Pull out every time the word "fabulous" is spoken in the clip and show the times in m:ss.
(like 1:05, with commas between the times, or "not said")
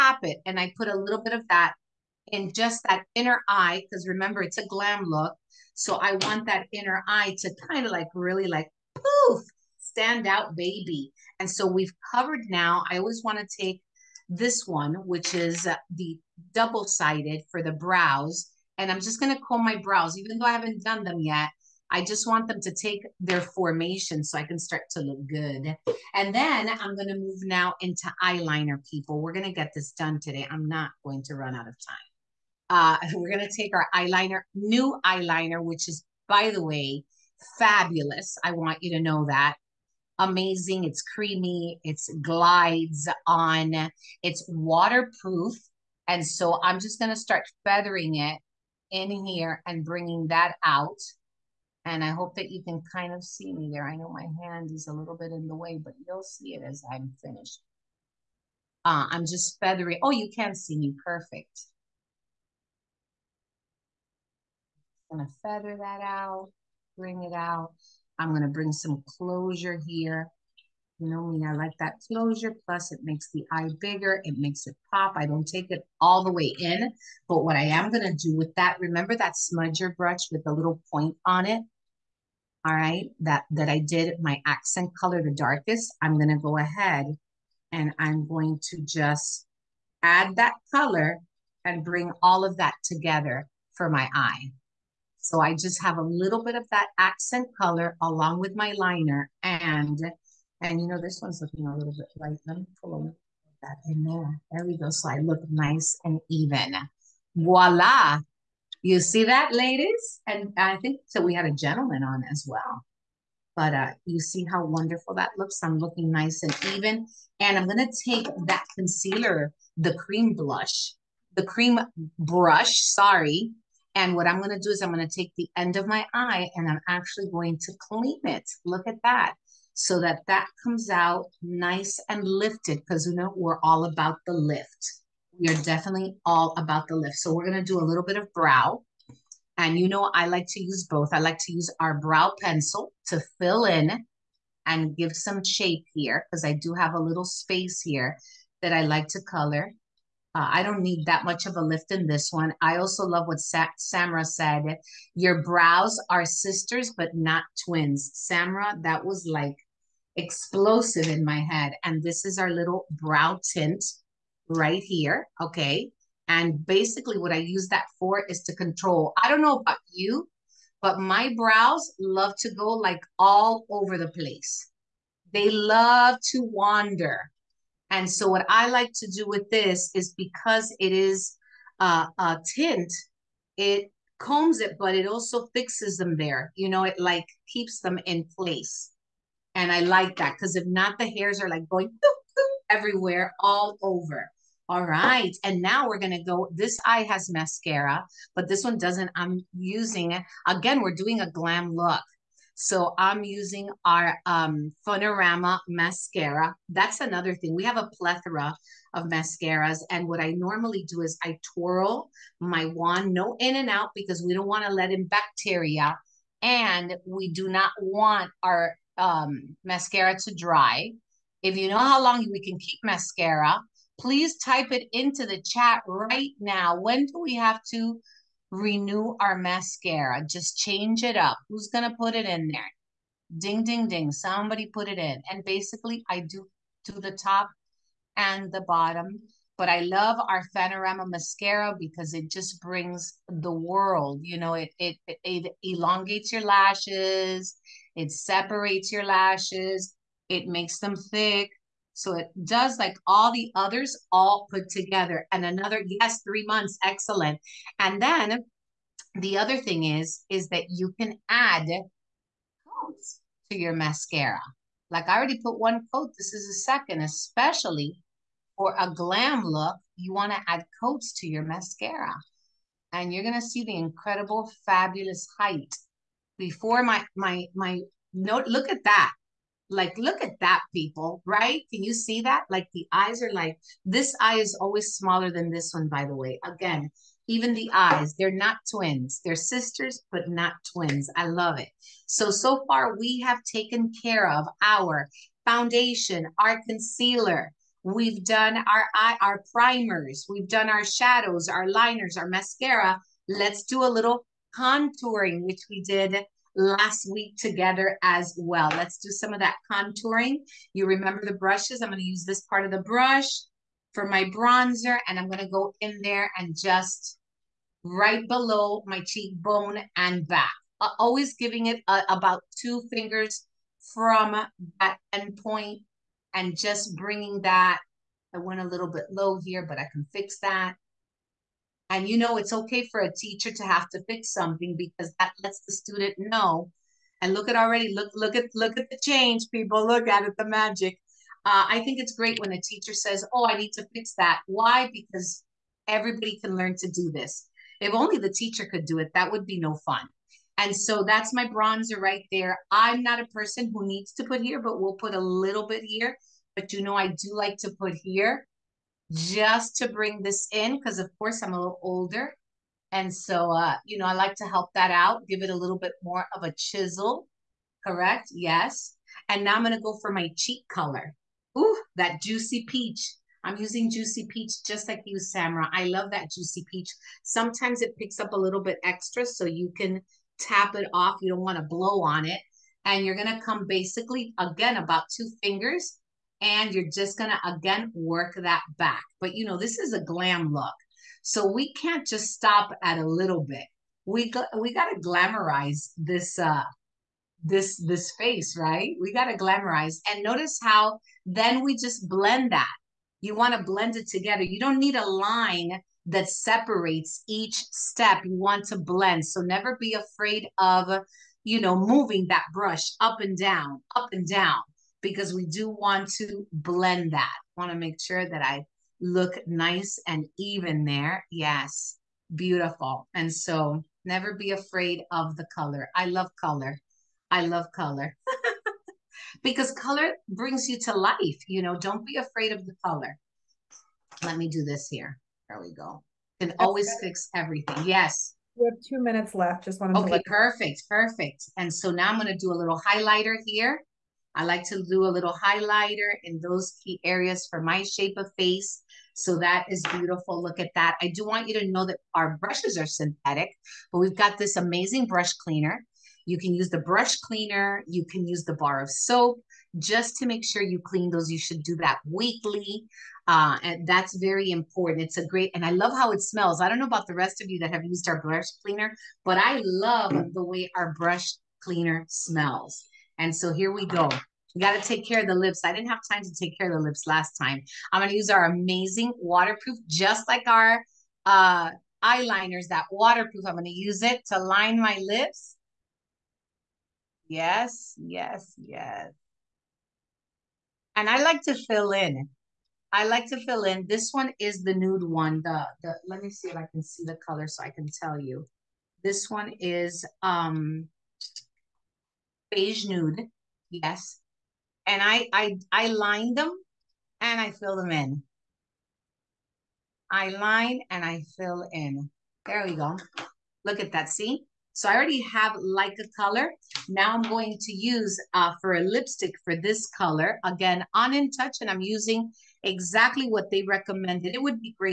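0:37, 4:34.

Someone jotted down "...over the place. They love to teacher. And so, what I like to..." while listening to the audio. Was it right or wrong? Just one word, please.
wrong.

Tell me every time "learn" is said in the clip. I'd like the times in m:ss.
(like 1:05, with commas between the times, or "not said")
5:46.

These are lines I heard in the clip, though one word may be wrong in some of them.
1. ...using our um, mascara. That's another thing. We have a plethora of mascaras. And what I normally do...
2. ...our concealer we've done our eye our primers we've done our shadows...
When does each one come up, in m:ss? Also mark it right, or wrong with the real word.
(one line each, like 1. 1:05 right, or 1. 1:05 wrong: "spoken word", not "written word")
1. 3:23 right
2. 4:56 right.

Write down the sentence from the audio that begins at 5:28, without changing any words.
I went a little bit low here, but I can fix that.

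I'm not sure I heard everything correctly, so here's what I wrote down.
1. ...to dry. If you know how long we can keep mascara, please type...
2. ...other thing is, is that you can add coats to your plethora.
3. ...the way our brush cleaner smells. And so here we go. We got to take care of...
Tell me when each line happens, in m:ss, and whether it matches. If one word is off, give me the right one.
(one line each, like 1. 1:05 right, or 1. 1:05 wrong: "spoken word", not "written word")
1. 3:40 right
2. 4:19 wrong: "mascara", not "plethora"
3. 7:50 right.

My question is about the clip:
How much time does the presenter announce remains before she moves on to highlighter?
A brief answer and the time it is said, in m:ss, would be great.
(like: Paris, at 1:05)
2 minutes, at 7:18.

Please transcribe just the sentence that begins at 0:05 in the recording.
So I want that inner eye to kind of like really like poof standout baby.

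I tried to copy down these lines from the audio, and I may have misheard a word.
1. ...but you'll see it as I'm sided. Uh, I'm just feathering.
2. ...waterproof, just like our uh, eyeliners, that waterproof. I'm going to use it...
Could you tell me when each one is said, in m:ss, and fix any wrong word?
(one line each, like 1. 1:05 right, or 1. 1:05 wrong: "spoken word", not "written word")
1. 0:55 wrong: "finished", not "sided"
2. 7:59 right.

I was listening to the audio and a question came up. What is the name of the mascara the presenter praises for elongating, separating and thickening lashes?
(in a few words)
Fanorama.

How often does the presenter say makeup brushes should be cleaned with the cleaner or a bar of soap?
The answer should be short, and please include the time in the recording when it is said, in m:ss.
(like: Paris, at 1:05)
Weekly, at 7:42.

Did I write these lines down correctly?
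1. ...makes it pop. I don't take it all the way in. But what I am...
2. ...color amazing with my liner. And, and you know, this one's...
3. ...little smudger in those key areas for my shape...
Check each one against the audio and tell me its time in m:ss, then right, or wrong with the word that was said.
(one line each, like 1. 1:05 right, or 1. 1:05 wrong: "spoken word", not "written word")
1. 1:14 right
2. 1:37 wrong: "along", not "amazing"
3. 7:25 wrong: "highlighter", not "smudger".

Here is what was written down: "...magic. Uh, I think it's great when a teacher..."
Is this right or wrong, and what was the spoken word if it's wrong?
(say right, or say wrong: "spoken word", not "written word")
right.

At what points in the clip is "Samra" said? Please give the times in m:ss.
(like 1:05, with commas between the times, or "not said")
2:33, 2:38, 6:15.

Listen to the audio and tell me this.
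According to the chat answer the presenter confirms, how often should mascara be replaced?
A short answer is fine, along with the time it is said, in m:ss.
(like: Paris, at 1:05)
3 months, at 4:16.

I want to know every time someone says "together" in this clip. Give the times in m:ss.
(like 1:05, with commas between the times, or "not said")
1:32, 4:14, 5:07, 6:44.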